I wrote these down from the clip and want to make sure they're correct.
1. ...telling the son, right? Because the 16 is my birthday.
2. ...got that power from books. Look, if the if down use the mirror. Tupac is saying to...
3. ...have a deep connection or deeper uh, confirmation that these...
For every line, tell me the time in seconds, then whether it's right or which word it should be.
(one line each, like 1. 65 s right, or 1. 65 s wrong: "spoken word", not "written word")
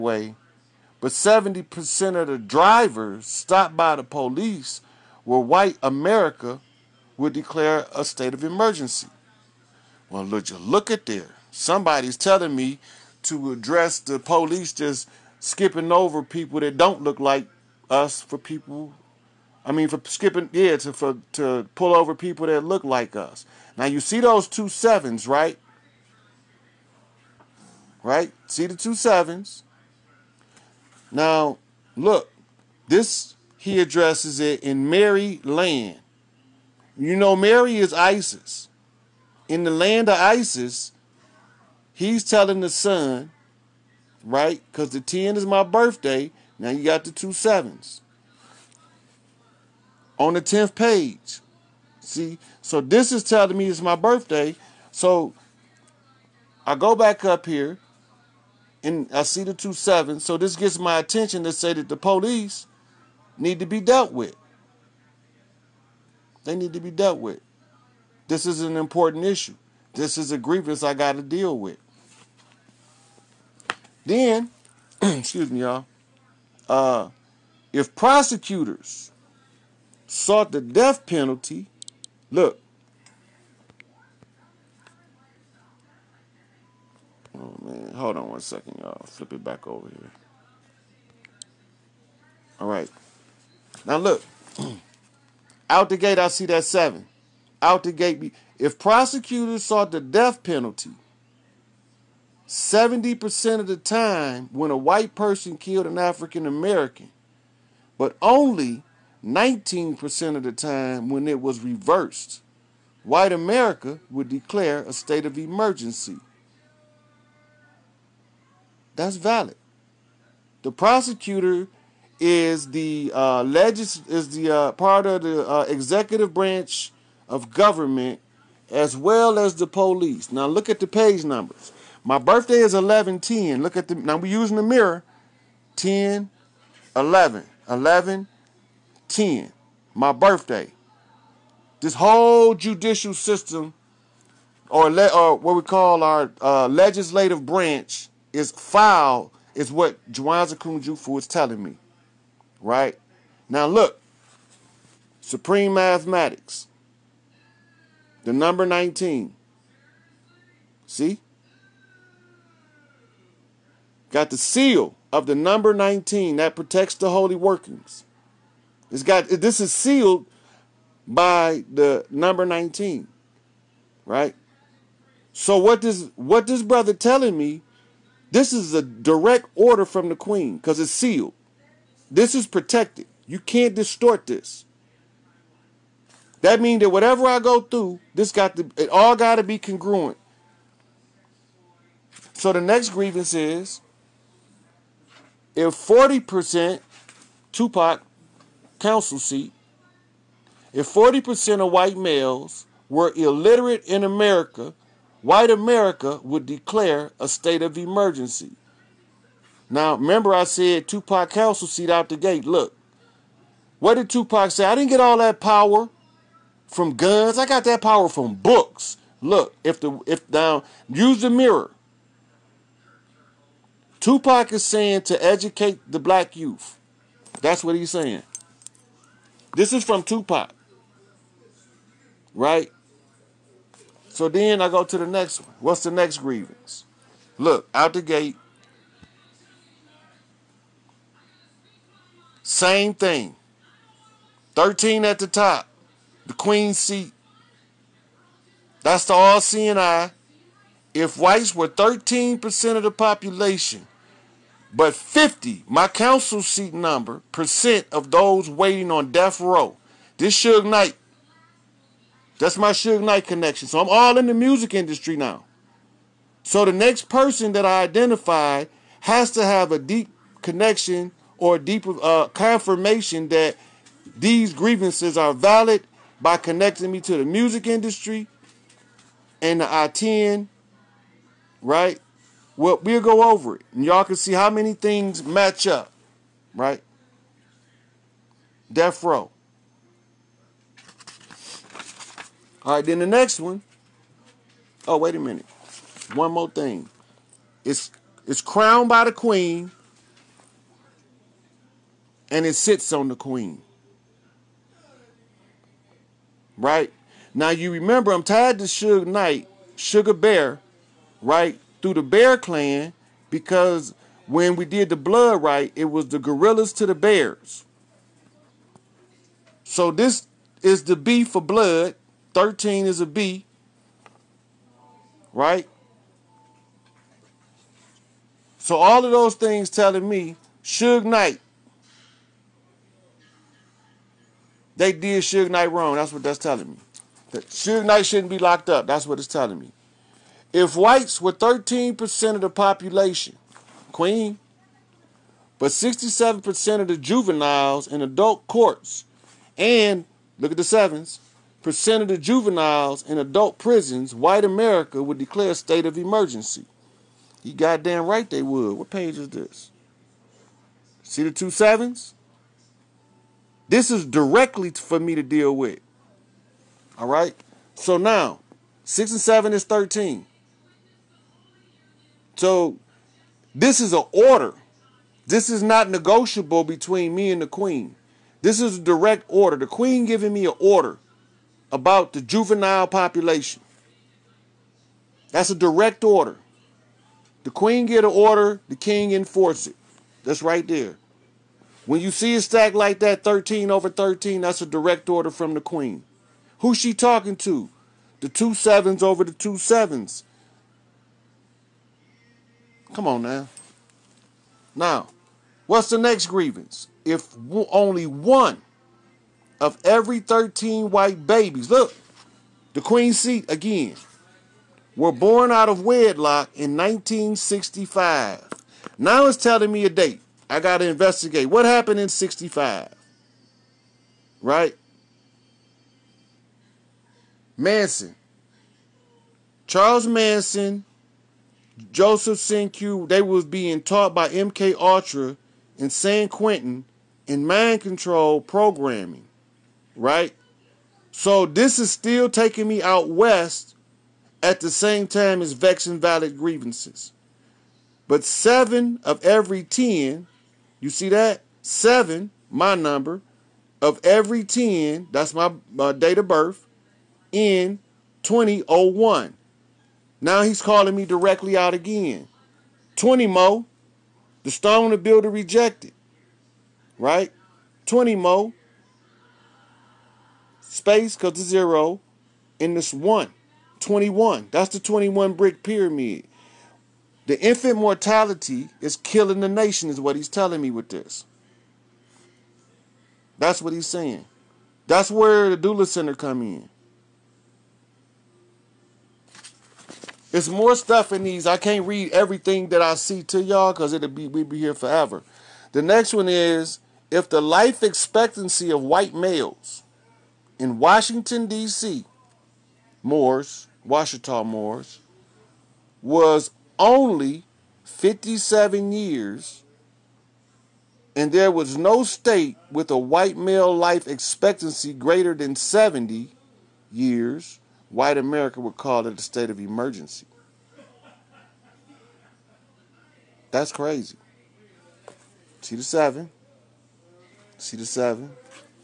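1. 42 s wrong: "10", not "16"
2. 217 s right
3. 269 s right.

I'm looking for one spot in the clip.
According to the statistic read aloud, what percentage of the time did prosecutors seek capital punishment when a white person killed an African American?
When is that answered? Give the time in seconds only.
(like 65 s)
102 s.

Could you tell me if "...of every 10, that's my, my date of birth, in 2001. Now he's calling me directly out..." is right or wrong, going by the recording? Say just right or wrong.
right.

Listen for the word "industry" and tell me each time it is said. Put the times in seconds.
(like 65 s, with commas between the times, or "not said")
264 s, 277 s.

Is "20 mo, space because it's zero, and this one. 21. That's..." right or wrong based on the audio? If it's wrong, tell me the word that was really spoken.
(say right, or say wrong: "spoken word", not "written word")
right.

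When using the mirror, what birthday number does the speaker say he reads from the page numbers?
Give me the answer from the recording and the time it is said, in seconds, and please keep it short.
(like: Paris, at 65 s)
1110, at 132 s.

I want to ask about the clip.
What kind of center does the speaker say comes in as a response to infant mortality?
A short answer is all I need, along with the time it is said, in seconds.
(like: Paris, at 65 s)
Doula center, at 485 s.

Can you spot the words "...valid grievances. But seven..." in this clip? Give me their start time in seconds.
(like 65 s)
445 s.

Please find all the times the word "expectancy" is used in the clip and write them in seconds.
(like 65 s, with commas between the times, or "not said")
497 s, 514 s.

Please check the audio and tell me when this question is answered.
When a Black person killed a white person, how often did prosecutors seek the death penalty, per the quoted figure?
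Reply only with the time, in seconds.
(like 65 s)
109 s.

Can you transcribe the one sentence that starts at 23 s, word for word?
Now you see those two sevens, right?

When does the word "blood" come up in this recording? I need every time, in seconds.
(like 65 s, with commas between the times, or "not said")
314 s, 321 s.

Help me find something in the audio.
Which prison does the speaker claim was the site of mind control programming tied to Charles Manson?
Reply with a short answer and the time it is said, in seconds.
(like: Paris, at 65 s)
San Quentin, at 435 s.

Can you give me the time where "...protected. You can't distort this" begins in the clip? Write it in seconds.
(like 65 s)
182 s.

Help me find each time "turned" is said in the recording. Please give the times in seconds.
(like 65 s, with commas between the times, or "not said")
not said.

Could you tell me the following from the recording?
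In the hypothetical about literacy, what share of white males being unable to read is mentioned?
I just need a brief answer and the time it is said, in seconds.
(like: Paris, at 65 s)
40%, at 200 s.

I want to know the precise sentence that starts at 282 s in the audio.
Well, we'll go over it and y'all can see how many things match up, right?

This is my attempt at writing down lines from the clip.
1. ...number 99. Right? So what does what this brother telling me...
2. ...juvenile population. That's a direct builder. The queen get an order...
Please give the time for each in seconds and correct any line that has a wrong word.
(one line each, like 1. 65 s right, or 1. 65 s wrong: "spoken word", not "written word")
1. 172 s wrong: "19", not "99"
2. 382 s wrong: "order", not "builder".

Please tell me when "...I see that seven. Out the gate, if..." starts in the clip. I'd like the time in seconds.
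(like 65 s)
96 s.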